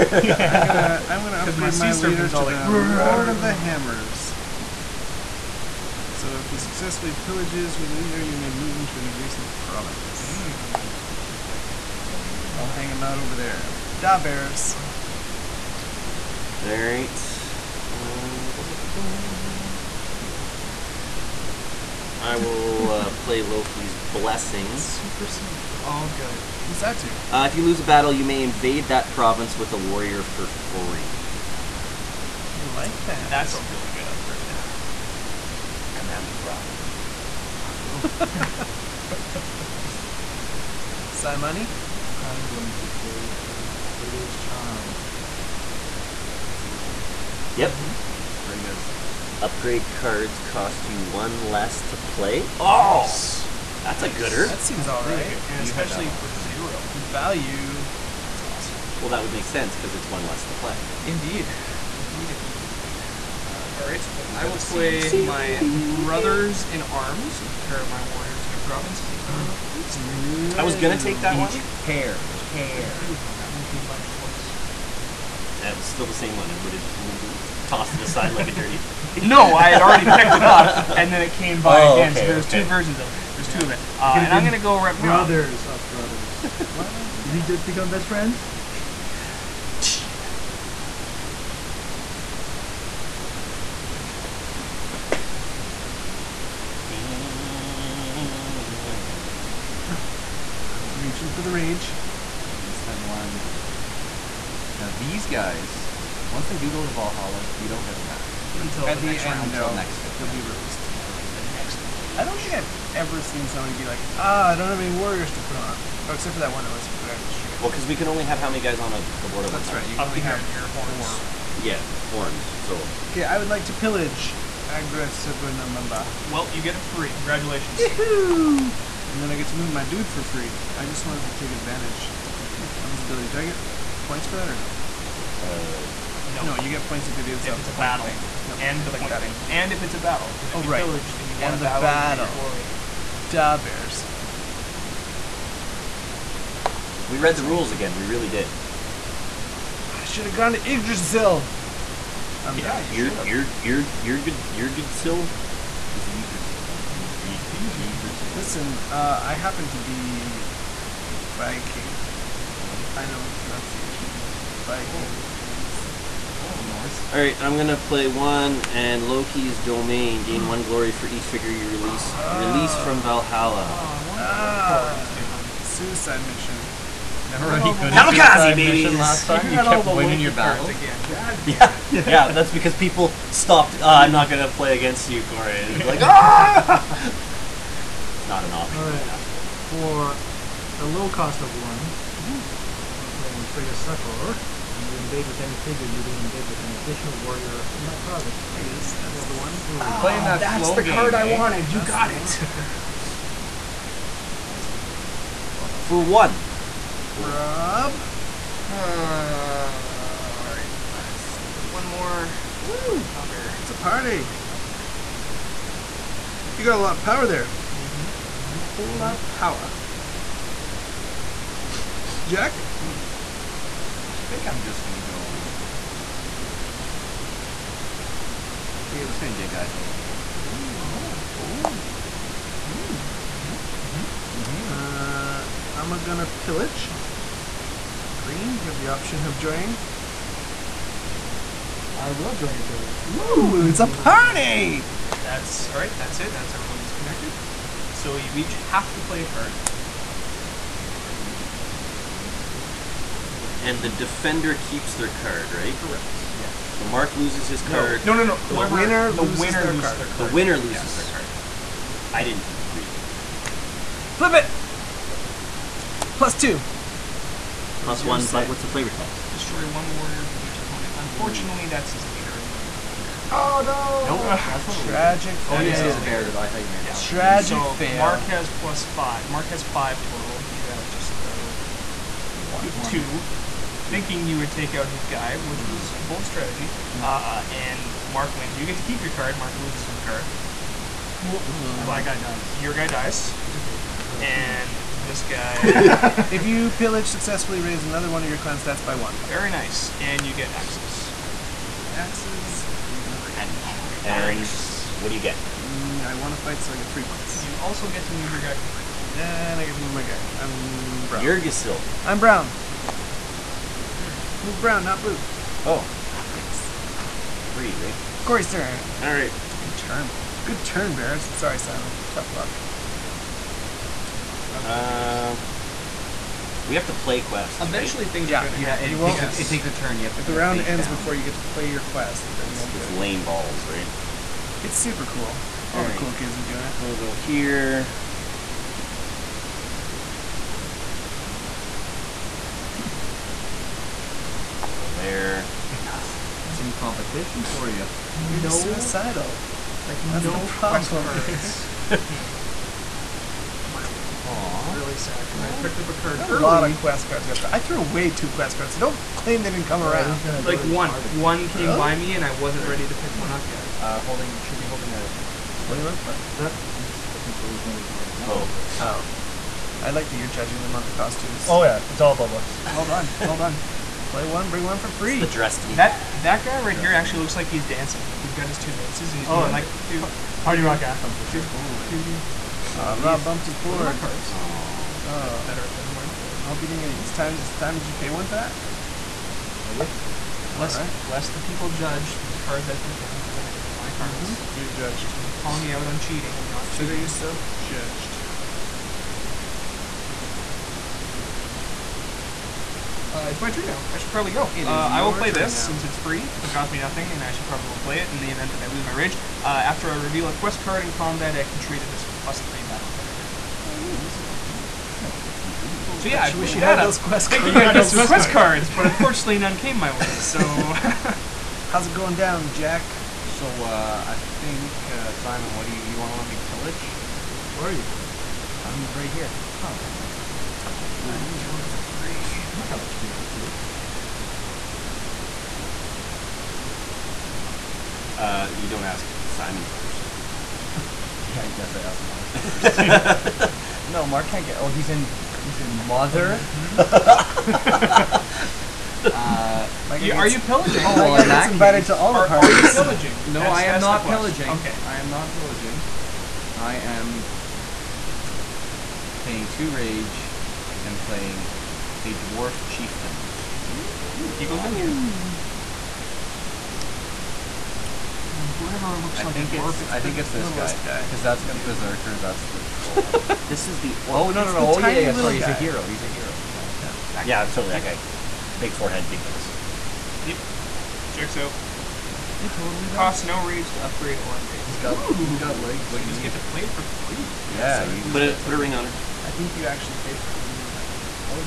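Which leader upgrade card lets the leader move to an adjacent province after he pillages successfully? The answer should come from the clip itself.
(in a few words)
Lord of the Hammers.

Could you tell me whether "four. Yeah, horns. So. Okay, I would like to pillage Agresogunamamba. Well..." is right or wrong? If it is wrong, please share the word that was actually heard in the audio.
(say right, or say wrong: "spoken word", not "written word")
right.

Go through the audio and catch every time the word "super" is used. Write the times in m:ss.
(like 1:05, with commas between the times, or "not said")
0:24, 5:34.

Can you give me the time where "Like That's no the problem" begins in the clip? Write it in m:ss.
5:49.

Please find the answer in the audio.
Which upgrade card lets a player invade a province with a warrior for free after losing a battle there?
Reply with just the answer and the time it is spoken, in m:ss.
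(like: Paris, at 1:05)
Loki's blessing, at 0:23.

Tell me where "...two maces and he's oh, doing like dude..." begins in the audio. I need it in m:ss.
6:18.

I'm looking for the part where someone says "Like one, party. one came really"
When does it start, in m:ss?
6:00.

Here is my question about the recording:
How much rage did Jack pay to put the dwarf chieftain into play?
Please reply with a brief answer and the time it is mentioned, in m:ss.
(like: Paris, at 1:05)
2, at 7:39.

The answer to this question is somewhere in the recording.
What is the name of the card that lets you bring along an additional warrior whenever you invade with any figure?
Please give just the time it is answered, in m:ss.
3:13.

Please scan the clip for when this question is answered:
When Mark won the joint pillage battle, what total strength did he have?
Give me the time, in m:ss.
4:39.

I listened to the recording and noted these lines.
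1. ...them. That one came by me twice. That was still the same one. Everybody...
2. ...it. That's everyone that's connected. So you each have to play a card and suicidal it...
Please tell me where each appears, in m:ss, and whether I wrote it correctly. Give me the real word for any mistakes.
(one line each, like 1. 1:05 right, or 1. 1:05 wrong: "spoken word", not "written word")
1. 1:13 right
2. 4:06 wrong: "reveal", not "suicidal".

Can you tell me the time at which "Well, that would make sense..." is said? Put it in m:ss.
0:58.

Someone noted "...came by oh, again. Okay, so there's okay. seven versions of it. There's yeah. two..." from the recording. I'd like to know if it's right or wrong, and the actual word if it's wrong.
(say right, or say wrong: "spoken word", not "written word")
wrong: "two", not "seven".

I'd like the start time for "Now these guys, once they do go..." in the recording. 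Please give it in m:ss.
1:44.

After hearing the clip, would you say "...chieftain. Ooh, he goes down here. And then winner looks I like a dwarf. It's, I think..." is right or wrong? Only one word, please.
wrong.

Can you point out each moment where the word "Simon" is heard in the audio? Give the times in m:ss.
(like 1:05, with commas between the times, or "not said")
5:21, 7:05, 7:19.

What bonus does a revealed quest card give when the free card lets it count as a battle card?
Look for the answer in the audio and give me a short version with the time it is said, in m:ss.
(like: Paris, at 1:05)
Plus 3, at 6:52.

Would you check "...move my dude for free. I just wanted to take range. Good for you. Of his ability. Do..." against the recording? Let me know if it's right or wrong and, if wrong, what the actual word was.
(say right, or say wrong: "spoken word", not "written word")
wrong: "advantage", not "range".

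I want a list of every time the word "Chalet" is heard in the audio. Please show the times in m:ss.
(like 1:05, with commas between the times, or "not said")
not said.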